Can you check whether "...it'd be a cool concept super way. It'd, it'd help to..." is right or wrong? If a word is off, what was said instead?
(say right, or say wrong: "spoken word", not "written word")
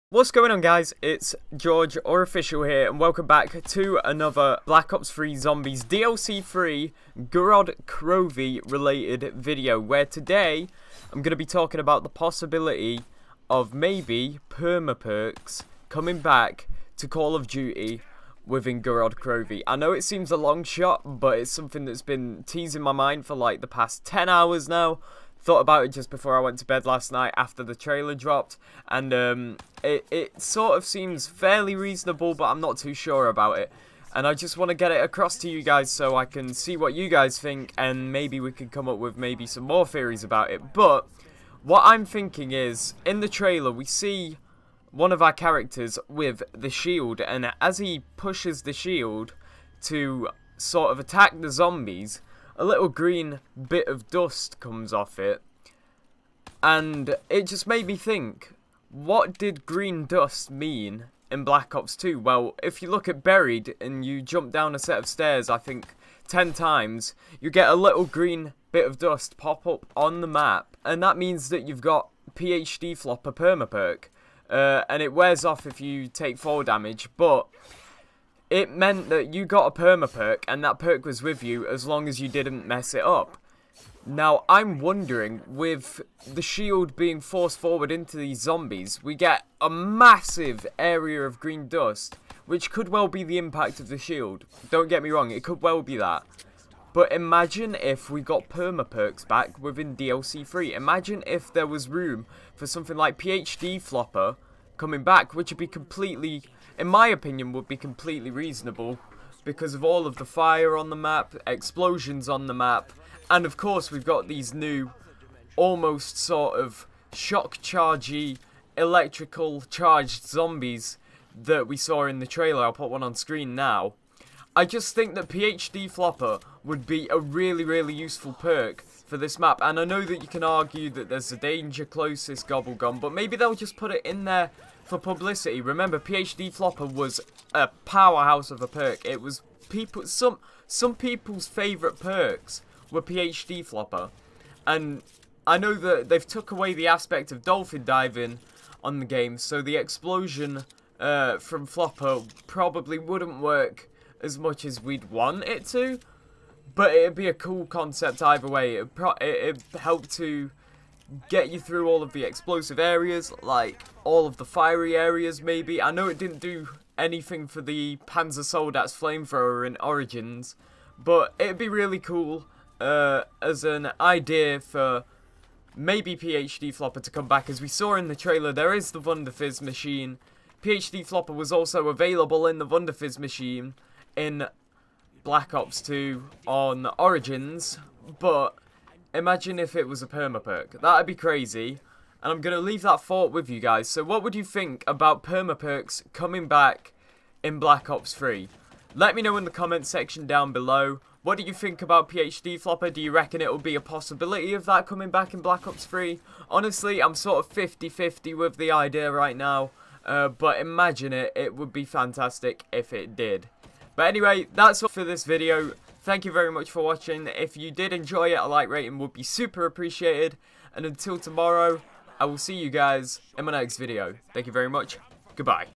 wrong: "either", not "super".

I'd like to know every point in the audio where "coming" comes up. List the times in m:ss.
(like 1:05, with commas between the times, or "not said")
0:15, 1:44, 3:16, 3:24.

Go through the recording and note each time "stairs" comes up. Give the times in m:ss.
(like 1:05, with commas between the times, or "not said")
1:05.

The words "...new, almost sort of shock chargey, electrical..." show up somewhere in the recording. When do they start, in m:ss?
1:54.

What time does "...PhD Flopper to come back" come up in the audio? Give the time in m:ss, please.
2:56.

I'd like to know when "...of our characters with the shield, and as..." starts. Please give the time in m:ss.
0:45.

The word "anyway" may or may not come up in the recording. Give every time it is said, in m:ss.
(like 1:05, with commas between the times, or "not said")
3:34.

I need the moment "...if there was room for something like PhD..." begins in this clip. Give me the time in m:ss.
1:41.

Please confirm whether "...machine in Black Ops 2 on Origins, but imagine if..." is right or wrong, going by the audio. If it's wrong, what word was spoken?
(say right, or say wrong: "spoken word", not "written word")
right.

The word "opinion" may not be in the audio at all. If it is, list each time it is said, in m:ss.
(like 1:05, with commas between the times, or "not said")
1:47.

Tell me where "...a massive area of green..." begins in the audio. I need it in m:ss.
1:29.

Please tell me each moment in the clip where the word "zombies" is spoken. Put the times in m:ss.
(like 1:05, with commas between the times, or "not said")
0:05, 0:51, 1:28, 2:00.